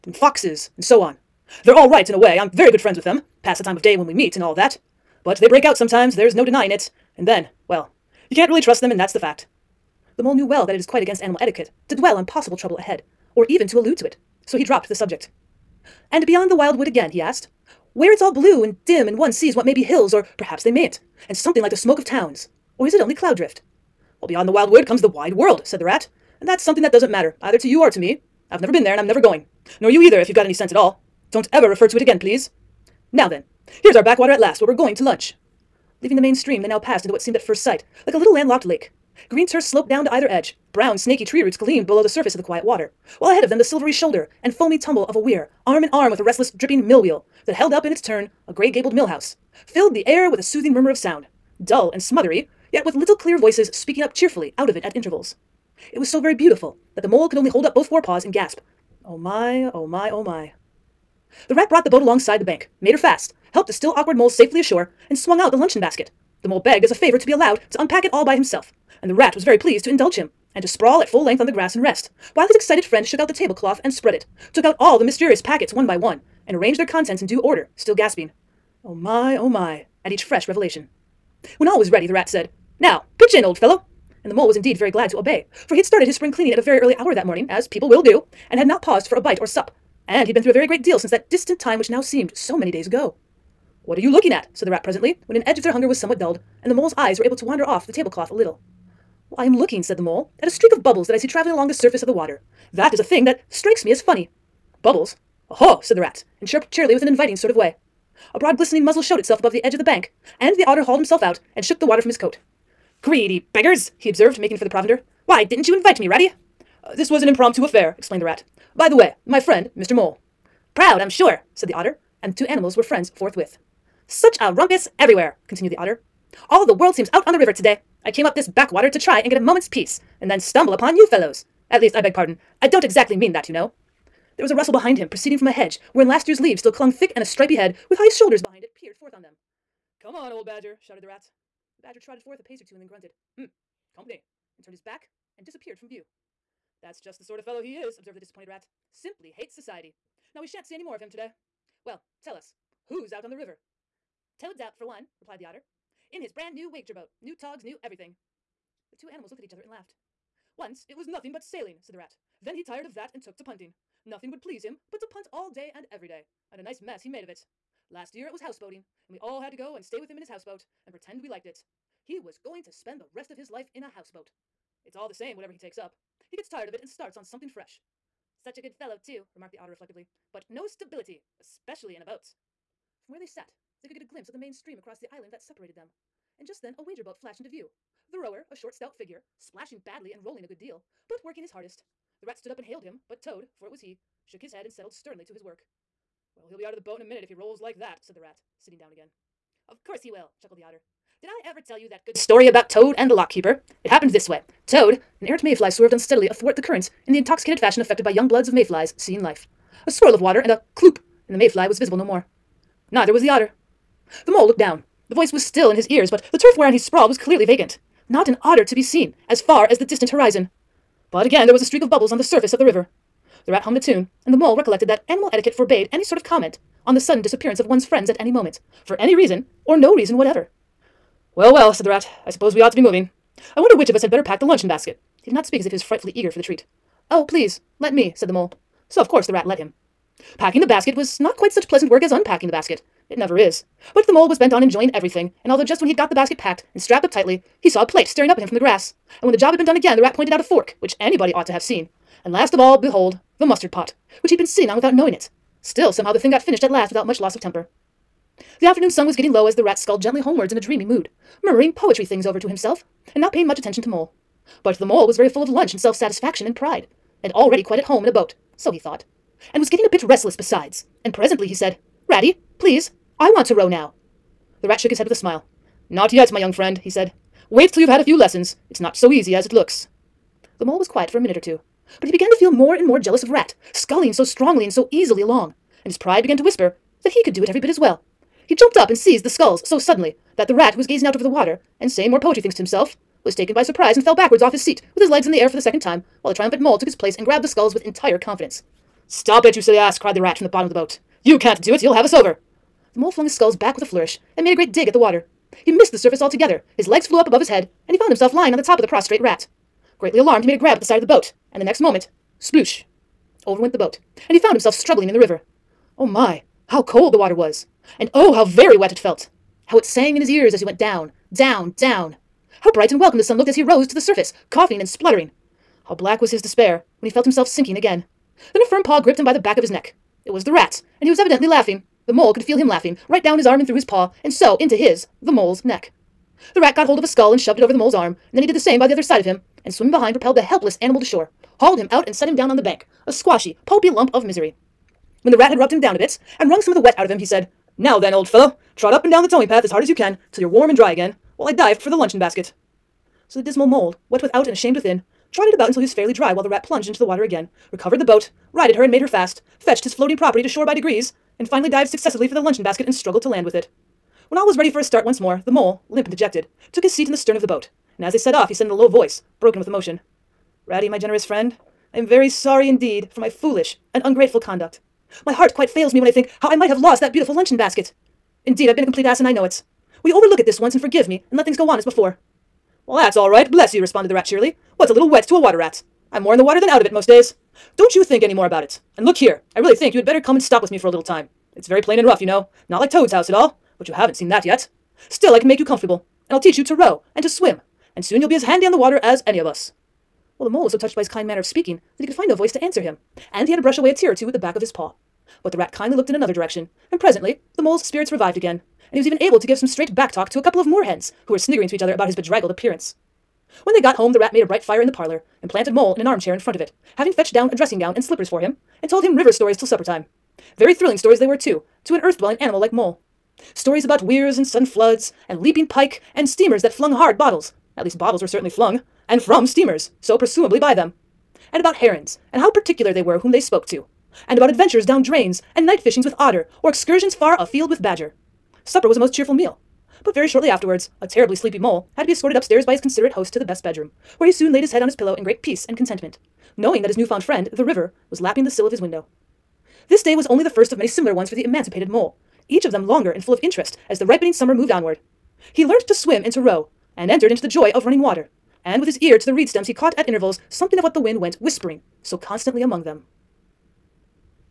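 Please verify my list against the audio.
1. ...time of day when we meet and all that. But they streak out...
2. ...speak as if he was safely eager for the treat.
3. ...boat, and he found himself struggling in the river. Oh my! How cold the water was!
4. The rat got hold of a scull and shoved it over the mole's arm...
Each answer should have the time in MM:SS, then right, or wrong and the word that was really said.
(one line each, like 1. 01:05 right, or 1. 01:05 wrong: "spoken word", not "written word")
1. 00:03 wrong: "break", not "streak"
2. 03:55 wrong: "frightfully", not "safely"
3. 05:13 right
4. 05:36 right.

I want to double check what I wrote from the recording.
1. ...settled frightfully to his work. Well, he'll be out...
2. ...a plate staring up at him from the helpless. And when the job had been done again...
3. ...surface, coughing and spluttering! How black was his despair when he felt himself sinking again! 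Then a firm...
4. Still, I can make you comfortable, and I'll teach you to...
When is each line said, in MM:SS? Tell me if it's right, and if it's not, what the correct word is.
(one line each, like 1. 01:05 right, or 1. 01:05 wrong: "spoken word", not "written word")
1. 03:14 wrong: "sternly", not "frightfully"
2. 04:07 wrong: "grass", not "helpless"
3. 05:23 right
4. 06:35 right.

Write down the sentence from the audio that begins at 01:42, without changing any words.
That is a thing that strikes me as funny.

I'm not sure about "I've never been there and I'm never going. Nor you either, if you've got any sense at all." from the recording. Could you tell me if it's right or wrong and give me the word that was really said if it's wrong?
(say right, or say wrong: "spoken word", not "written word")
right.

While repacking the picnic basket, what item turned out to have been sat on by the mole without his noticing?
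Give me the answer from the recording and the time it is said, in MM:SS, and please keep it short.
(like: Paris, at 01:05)
the mustard pot, at 04:13.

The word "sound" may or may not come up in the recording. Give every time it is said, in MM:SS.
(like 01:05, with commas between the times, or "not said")
00:50.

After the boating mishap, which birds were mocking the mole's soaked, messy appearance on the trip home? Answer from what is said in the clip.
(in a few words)
moorhens.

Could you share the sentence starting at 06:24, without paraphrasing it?
What's a little wet to a water rat?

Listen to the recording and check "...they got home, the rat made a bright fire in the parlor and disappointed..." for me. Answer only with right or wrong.
wrong.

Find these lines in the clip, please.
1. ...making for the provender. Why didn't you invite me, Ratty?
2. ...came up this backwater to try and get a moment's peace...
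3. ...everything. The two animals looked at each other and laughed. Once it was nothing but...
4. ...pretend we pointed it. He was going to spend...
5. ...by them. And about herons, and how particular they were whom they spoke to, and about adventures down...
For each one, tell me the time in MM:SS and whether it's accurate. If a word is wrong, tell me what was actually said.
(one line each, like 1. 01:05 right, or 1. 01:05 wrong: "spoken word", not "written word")
1. 01:54 right
2. 02:08 right
3. 02:37 right
4. 02:50 wrong: "liked", not "pointed"
5. 07:10 right.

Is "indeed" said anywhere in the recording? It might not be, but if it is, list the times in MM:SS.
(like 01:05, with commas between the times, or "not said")
01:24, 06:12, 06:18.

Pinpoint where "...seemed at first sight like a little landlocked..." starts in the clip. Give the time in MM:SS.
00:37.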